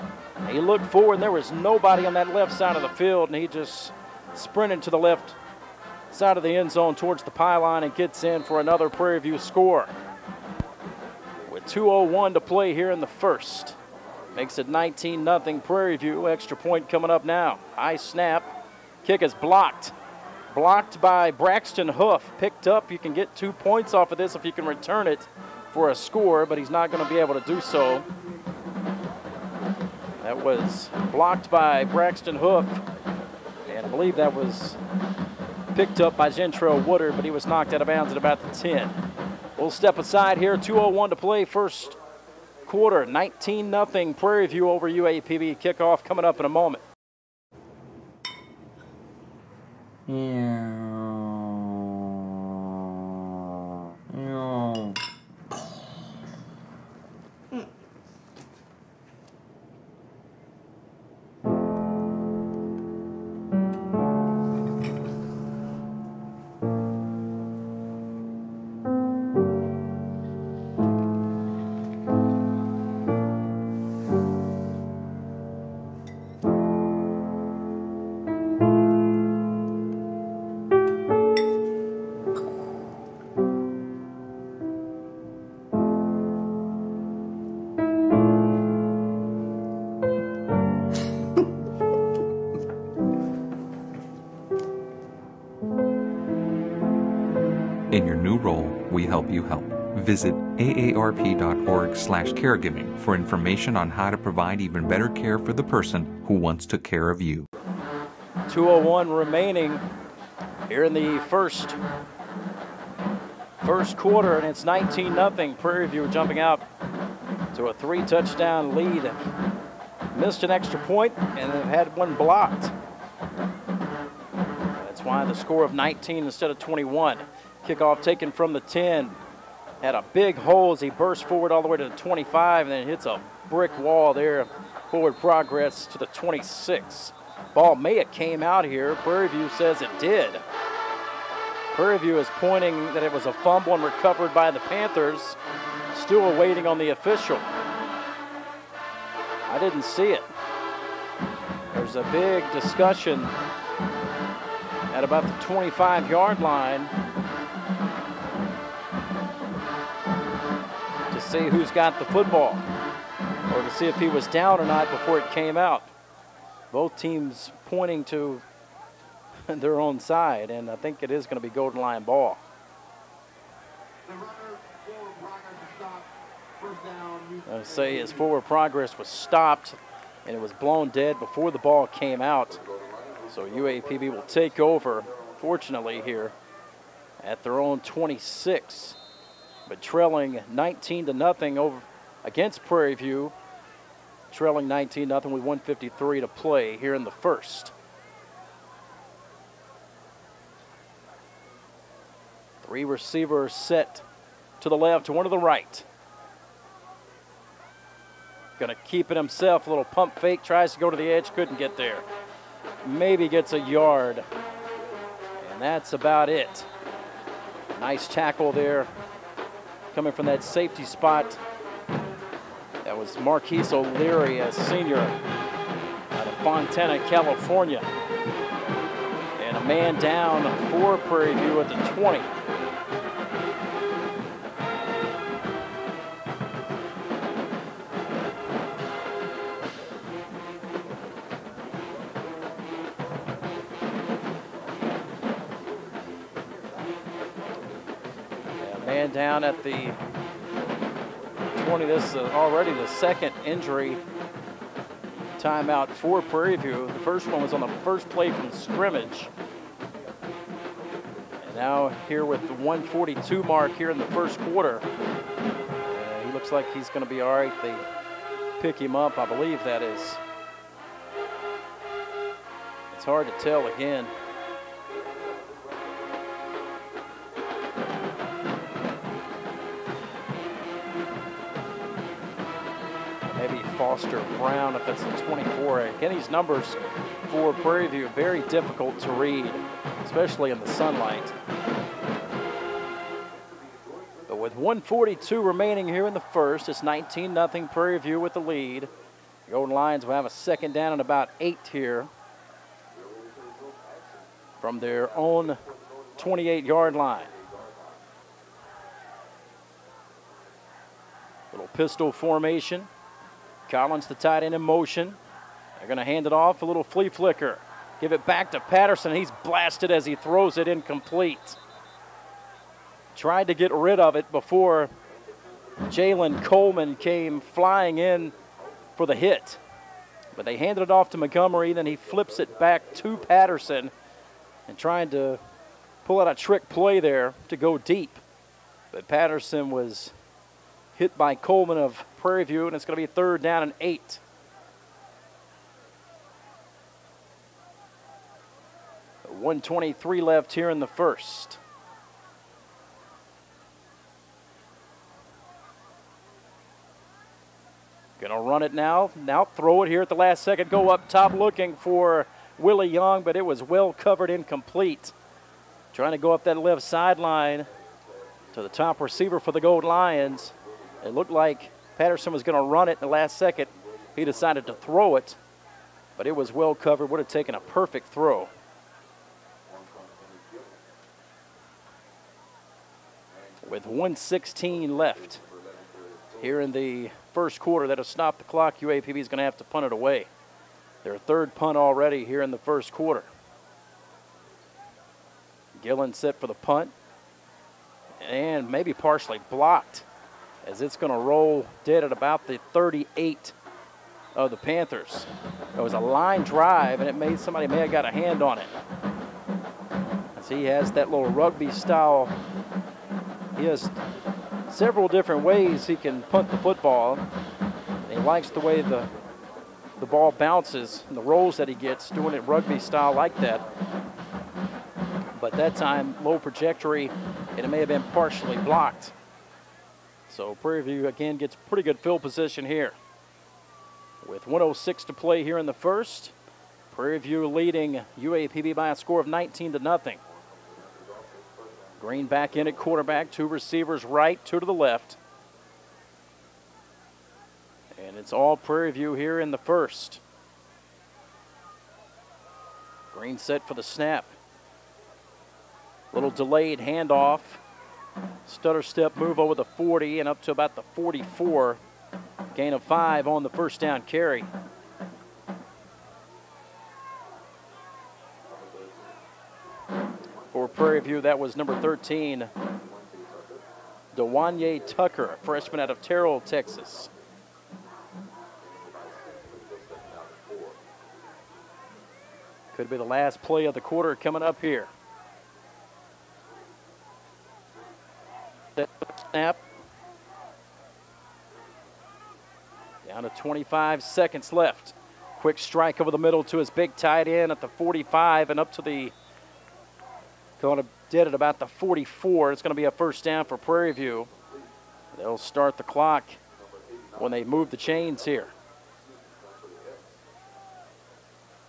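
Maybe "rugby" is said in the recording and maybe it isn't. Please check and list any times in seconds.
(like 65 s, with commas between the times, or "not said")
411 s, 422 s.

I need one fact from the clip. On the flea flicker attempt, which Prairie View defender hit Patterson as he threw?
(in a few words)
Jalen Coleman.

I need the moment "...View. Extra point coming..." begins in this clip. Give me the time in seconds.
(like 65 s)
15 s.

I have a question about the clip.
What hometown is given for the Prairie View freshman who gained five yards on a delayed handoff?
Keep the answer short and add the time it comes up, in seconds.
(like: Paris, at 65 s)
Terrell, Texas, at 476 s.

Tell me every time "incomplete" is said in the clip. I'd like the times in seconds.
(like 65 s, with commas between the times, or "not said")
320 s, 364 s.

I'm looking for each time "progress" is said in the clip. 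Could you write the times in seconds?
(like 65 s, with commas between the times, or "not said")
135 s, 178 s.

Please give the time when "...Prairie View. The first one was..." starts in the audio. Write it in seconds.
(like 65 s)
256 s.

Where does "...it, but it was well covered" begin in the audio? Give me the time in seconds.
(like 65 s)
375 s.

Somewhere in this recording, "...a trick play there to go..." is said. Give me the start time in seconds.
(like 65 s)
336 s.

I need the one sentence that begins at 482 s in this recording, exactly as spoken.
Could be the last play of the quarter coming up here.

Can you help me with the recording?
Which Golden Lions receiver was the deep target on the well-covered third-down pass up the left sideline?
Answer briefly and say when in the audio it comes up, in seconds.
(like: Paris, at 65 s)
Willie Young, at 362 s.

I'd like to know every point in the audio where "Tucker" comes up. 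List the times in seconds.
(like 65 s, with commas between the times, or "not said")
474 s.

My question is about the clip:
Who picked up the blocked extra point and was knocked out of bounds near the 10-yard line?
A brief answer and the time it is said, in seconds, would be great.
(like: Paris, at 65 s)
Gentrell Woodard, at 36 s.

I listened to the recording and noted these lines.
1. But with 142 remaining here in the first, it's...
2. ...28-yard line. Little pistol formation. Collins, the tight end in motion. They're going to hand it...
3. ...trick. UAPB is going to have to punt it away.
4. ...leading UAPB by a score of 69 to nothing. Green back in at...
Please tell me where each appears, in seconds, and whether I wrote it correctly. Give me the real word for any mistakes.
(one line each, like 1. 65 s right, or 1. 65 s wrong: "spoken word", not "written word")
1. 294 s right
2. 306 s right
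3. 388 s wrong: "clock", not "trick"
4. 437 s wrong: "19", not "69".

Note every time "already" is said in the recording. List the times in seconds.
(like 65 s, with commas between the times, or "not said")
252 s, 391 s.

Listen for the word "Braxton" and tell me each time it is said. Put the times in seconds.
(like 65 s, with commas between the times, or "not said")
21 s, 31 s.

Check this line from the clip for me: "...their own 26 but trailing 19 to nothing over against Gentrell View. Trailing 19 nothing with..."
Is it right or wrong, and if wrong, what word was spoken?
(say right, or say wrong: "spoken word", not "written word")
wrong: "Prairie", not "Gentrell".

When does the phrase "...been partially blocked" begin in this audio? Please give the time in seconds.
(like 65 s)
427 s.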